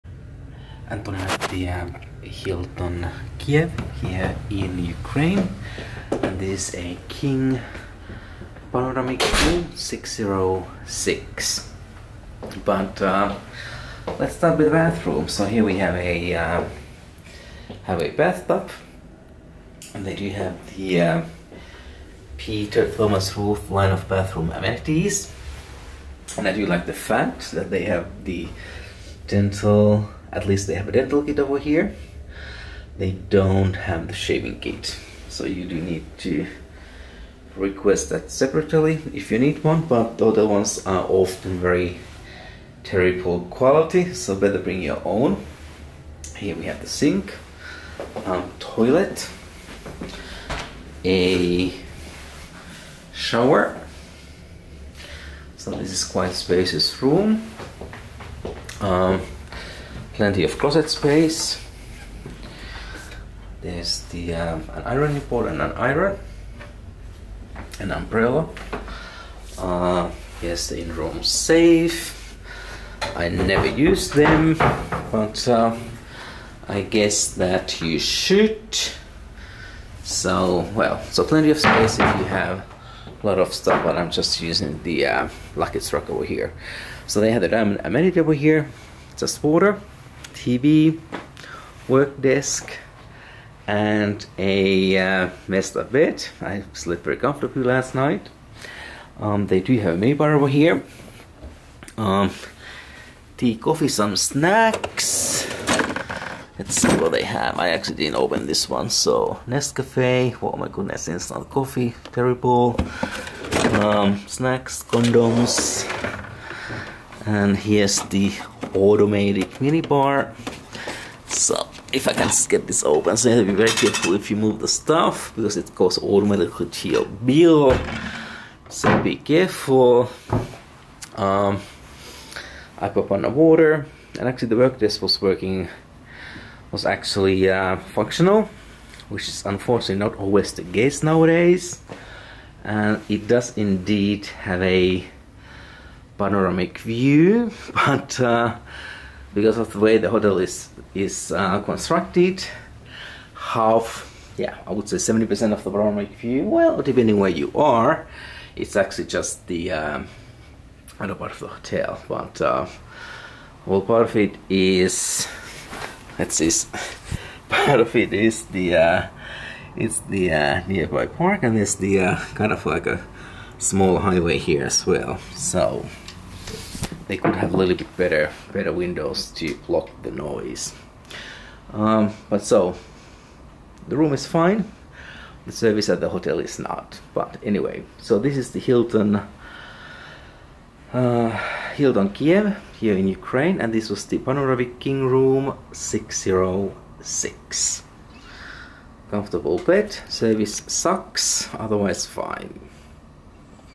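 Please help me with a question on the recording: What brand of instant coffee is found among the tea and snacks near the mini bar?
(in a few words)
Nescafe.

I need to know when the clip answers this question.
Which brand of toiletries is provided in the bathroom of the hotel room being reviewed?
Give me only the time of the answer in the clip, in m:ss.
0:22.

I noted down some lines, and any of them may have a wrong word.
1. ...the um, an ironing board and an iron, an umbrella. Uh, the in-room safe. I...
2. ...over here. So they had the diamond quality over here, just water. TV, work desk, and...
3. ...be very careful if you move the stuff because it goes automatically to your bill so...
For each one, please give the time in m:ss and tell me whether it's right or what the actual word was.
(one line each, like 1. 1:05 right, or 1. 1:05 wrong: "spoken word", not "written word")
1. 1:04 right
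2. 1:26 wrong: "amenity", not "quality"
3. 2:03 right.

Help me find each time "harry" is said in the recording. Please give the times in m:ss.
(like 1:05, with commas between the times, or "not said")
not said.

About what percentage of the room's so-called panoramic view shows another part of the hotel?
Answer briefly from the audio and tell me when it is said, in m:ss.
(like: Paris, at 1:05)
70%, at 2:34.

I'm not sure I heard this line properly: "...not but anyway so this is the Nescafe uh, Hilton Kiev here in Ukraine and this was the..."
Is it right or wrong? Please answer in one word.
wrong.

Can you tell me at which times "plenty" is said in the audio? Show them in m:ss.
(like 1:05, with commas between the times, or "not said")
1:00, 1:21.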